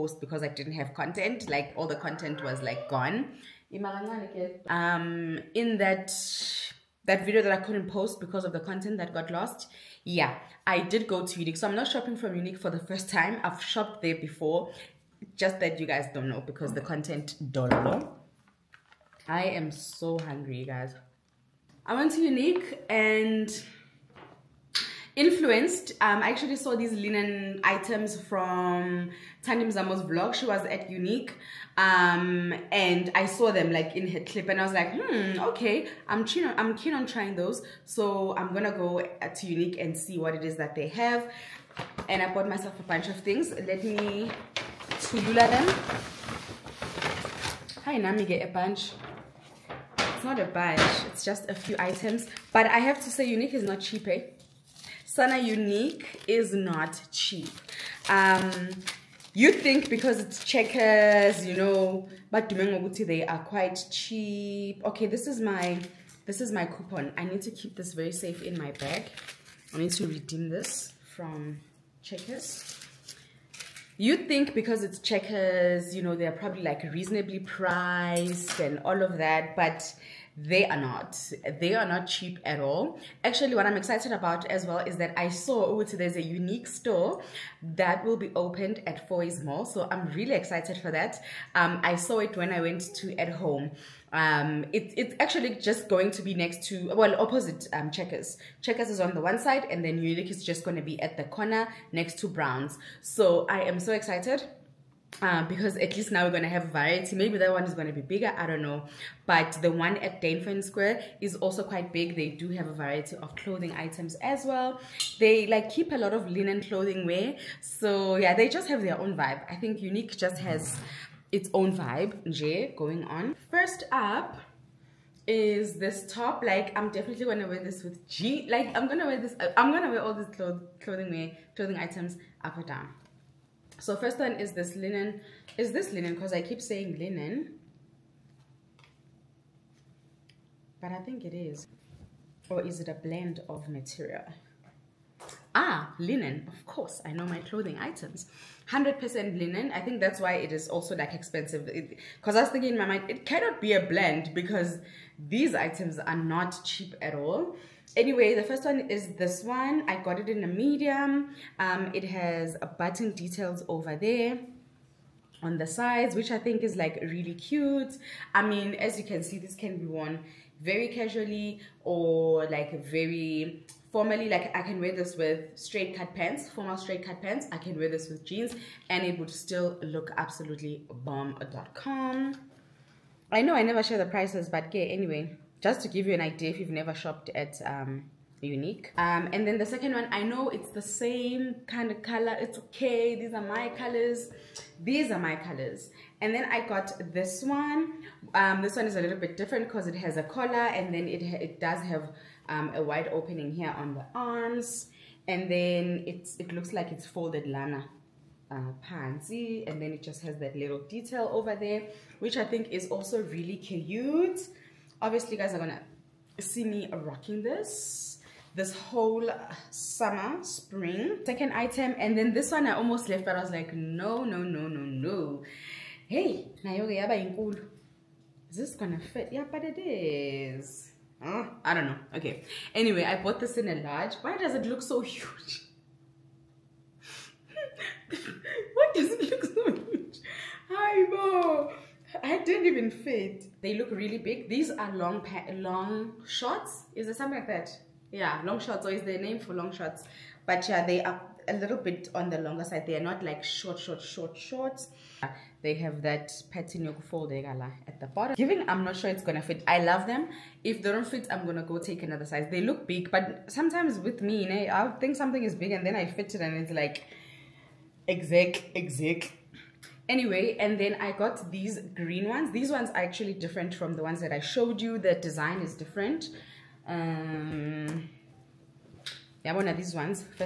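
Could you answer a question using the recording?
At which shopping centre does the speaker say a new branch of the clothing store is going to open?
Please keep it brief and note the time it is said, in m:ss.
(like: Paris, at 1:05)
Fourways Mall, at 1:29.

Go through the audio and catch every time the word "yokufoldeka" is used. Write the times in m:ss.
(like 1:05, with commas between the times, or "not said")
4:16.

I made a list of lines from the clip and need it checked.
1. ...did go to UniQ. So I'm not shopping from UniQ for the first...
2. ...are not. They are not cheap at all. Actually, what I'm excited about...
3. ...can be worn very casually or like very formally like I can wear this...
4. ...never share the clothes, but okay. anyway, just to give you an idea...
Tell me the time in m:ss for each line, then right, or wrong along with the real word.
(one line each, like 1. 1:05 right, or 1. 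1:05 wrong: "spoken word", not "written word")
1. 0:10 right
2. 1:20 right
3. 2:49 right
4. 3:03 wrong: "prices", not "clothes".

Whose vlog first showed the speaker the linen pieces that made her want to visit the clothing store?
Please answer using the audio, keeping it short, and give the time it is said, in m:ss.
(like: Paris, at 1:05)
Tandim Zamo, at 0:29.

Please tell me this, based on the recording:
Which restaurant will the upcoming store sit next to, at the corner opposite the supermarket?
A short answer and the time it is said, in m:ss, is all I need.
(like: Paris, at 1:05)
Browns, at 1:42.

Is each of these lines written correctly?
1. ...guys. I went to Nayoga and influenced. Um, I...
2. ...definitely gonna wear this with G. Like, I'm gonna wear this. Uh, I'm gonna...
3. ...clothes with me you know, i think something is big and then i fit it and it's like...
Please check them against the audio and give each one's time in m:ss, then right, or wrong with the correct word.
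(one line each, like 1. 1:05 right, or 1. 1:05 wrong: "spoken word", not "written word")
1. 0:20 wrong: "UniQ", not "Nayoga"
2. 2:06 right
3. 4:23 wrong: "sometimes", not "clothes".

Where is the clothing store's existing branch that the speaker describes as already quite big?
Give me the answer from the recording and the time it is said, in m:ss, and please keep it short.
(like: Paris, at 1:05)
Dainfern Square, at 1:50.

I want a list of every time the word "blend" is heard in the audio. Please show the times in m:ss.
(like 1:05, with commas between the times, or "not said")
2:22, 2:33.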